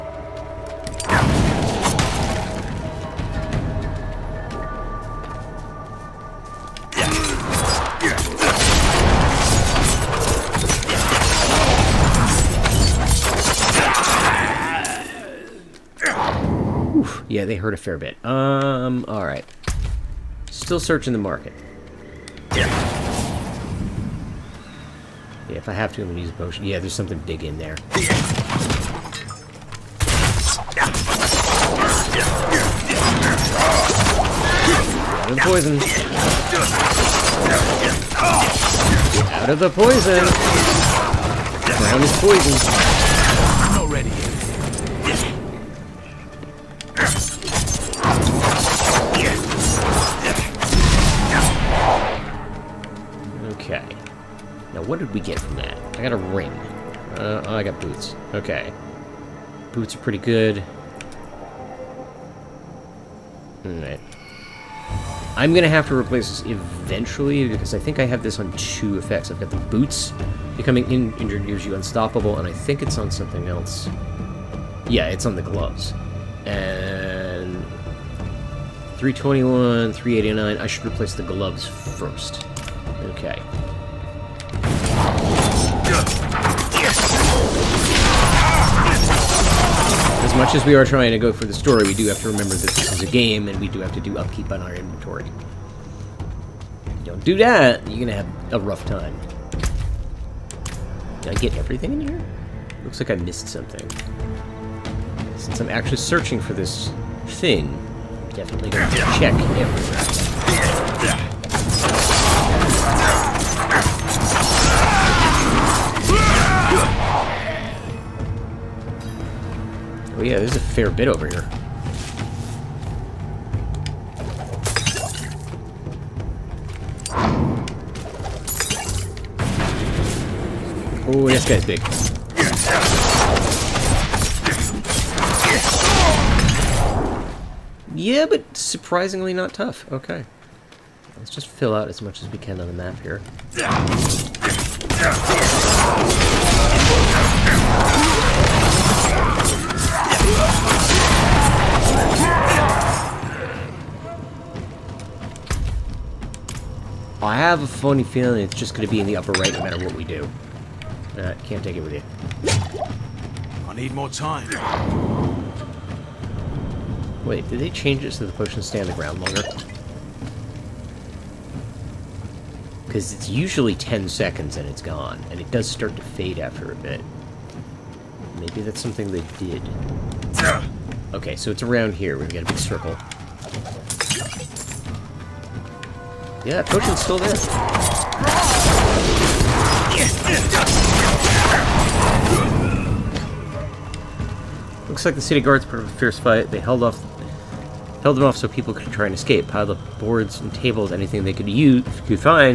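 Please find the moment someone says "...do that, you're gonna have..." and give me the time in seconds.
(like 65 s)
97 s.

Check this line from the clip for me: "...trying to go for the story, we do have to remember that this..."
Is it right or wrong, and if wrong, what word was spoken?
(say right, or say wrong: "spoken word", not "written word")
right.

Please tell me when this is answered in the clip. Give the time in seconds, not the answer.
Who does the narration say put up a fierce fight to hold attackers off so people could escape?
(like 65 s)
195 s.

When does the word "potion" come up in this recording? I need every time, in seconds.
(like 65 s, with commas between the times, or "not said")
26 s, 168 s.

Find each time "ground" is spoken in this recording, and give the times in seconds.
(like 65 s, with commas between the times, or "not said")
41 s, 168 s.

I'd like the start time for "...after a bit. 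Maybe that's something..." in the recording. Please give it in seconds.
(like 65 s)
176 s.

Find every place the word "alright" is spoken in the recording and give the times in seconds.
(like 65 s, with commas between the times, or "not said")
19 s, 63 s.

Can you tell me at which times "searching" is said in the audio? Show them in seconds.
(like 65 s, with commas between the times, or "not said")
20 s, 105 s.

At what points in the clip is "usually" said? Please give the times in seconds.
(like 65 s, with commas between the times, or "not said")
173 s.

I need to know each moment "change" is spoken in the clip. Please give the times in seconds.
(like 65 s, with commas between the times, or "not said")
167 s.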